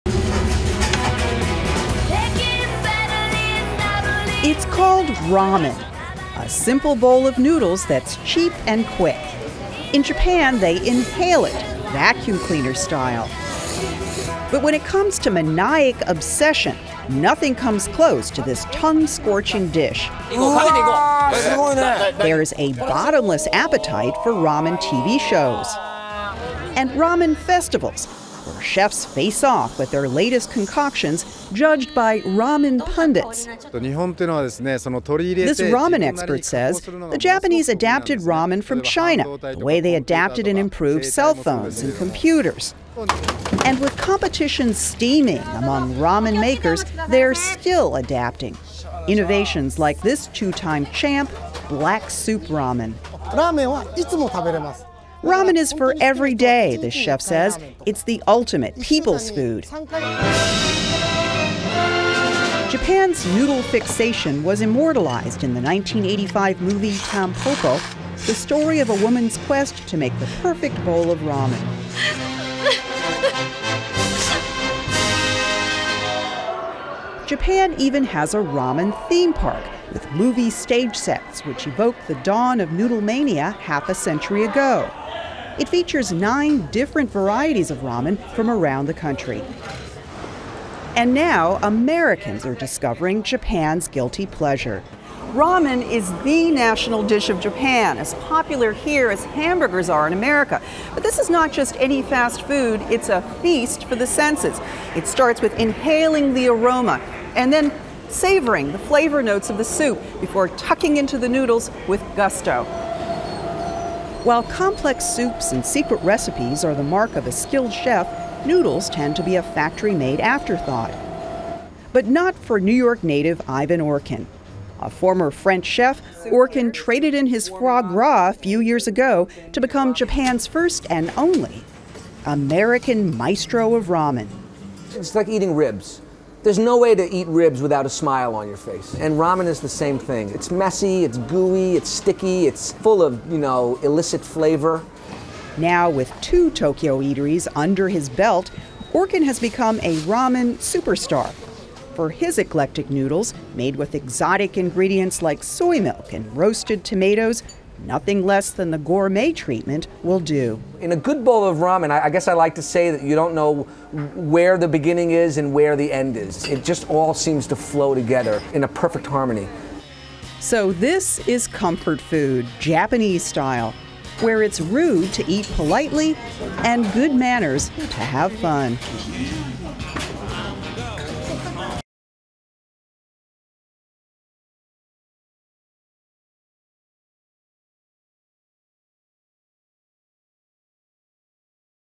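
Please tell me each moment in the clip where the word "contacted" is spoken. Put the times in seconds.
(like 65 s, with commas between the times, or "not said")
not said.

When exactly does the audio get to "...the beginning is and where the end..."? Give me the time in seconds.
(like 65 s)
164 s.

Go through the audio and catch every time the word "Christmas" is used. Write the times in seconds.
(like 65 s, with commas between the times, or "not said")
not said.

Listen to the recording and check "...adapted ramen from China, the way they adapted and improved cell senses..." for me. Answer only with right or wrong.
wrong.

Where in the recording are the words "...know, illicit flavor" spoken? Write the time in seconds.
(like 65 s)
143 s.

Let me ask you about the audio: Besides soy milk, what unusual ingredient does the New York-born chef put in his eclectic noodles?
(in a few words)
roasted tomatoes.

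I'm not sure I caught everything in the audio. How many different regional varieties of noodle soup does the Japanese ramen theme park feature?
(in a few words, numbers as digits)
9.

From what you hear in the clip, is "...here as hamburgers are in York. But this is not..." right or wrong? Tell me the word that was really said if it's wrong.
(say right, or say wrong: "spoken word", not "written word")
wrong: "America", not "York".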